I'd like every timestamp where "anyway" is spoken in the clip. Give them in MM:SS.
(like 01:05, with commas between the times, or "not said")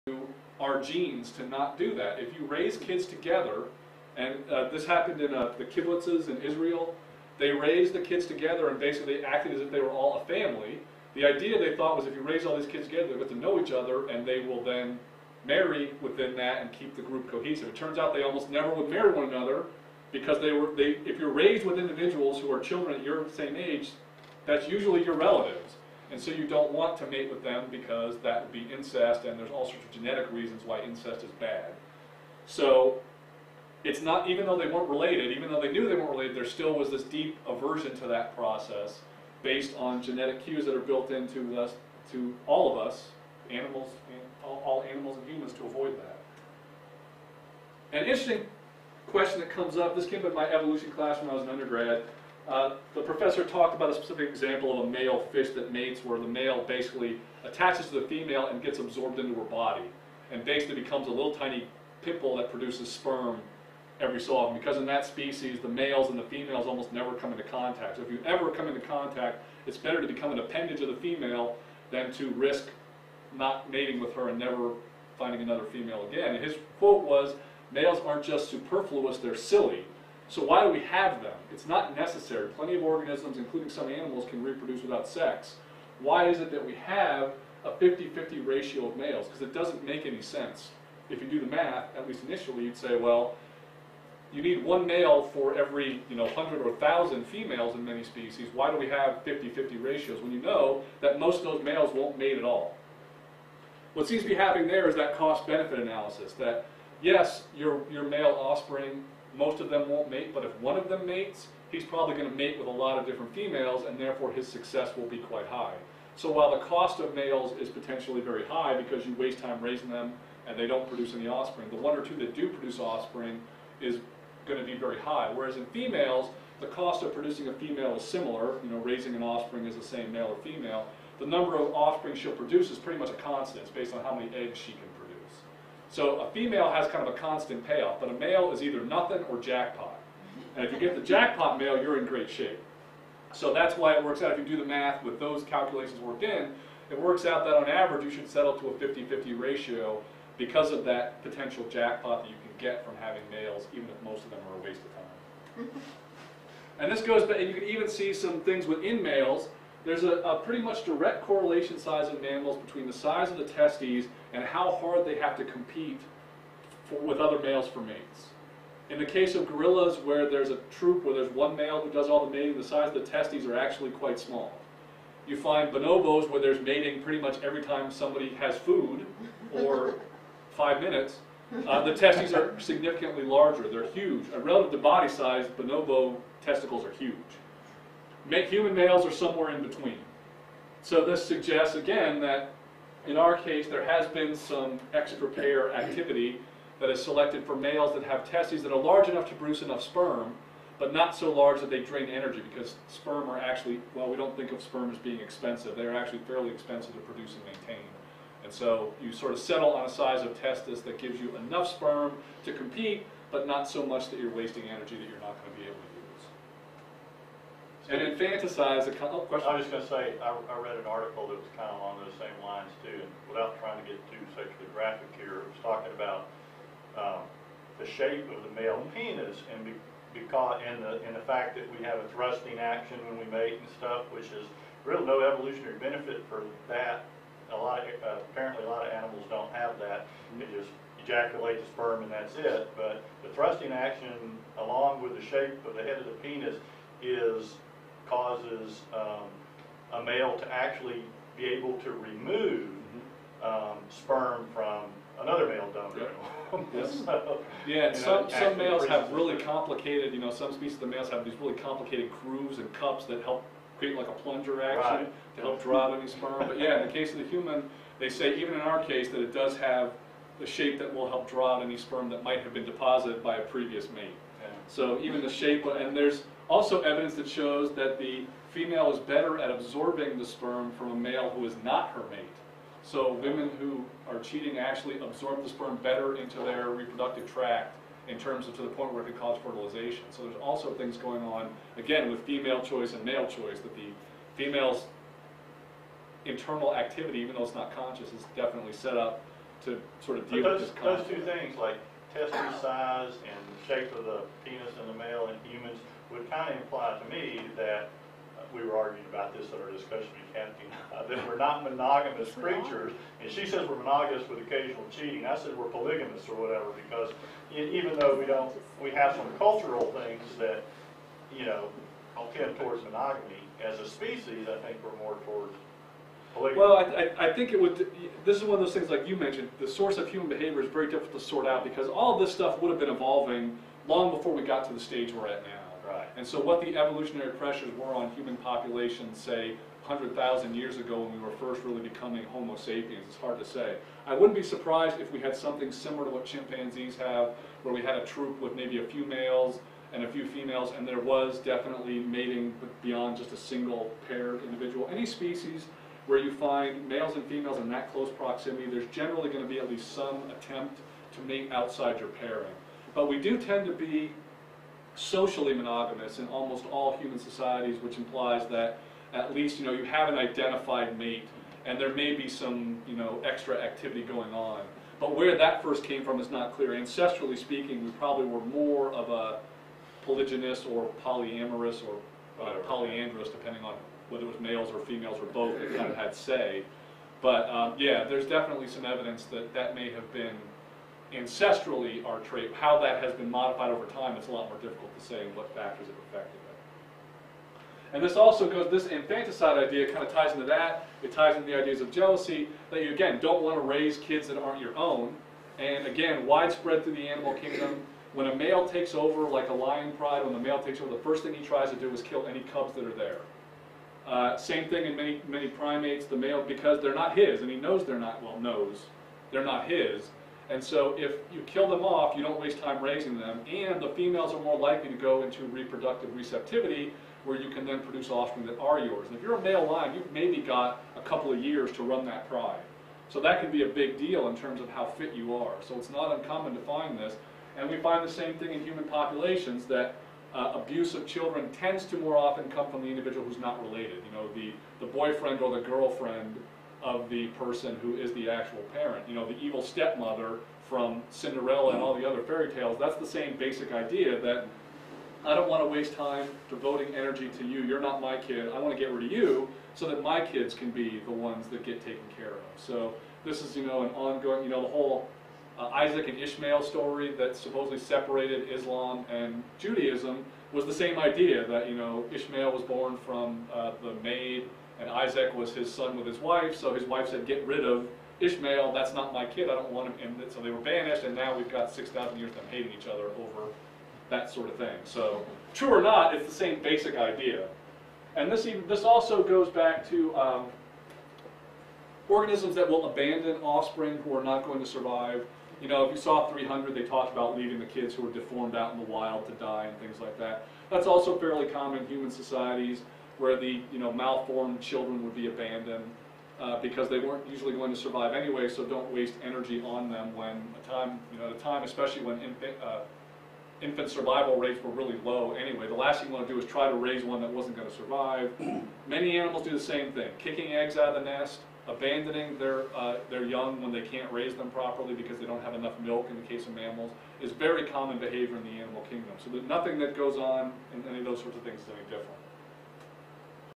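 08:28, 08:35.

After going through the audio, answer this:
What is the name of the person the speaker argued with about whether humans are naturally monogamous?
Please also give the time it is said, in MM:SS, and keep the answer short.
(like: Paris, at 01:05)
Kathy, at 05:10.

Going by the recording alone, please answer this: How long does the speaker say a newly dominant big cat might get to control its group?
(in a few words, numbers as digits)
A couple of years.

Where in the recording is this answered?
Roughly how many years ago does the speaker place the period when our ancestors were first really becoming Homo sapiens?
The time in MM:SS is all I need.
05:39.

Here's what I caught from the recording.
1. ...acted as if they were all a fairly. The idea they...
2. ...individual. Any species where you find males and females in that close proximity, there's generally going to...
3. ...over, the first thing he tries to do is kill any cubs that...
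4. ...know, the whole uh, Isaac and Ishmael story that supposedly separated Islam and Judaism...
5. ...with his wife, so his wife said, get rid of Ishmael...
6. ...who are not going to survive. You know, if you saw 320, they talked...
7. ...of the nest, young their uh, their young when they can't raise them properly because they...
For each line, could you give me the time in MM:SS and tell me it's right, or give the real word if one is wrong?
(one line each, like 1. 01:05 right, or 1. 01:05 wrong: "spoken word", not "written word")
1. 00:09 wrong: "family", not "fairly"
2. 05:54 right
3. 06:50 right
4. 07:44 right
5. 07:55 right
6. 08:14 wrong: "300", not "320"
7. 08:40 wrong: "abandoning", not "young".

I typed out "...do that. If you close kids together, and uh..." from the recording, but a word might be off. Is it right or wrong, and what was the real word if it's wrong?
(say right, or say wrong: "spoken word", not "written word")
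wrong: "raise", not "close".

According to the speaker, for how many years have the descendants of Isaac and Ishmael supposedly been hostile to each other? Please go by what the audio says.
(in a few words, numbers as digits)
6,000 years.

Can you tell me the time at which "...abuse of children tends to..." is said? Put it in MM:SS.
07:20.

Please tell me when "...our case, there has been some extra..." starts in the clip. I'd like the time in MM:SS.
03:13.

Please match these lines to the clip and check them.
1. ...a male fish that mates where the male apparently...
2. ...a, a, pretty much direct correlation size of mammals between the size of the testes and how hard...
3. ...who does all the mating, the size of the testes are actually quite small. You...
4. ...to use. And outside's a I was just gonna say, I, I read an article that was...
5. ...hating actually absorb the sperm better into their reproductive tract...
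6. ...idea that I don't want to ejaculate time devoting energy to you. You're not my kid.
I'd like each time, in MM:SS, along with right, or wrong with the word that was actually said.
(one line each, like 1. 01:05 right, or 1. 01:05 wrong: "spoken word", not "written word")
1. 00:54 wrong: "basically", not "apparently"
2. 02:40 right
3. 02:51 right
4. 03:35 wrong: "infanticide", not "outside"
5. 04:44 wrong: "cheating", not "hating"
6. 07:33 wrong: "waste", not "ejaculate".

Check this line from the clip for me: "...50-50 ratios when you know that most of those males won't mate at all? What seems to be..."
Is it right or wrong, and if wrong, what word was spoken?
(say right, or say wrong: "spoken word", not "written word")
right.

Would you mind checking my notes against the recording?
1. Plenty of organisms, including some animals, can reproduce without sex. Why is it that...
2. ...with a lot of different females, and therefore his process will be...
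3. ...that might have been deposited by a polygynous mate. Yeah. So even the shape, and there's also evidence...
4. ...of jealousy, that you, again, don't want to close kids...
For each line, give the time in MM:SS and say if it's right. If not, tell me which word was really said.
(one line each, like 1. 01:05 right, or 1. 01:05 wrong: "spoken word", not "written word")
1. 01:22 right
2. 01:52 wrong: "success", not "process"
3. 04:32 wrong: "previous", not "polygynous"
4. 06:41 wrong: "raise", not "close".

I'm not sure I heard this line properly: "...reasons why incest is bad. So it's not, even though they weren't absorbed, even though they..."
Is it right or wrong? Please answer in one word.
wrong.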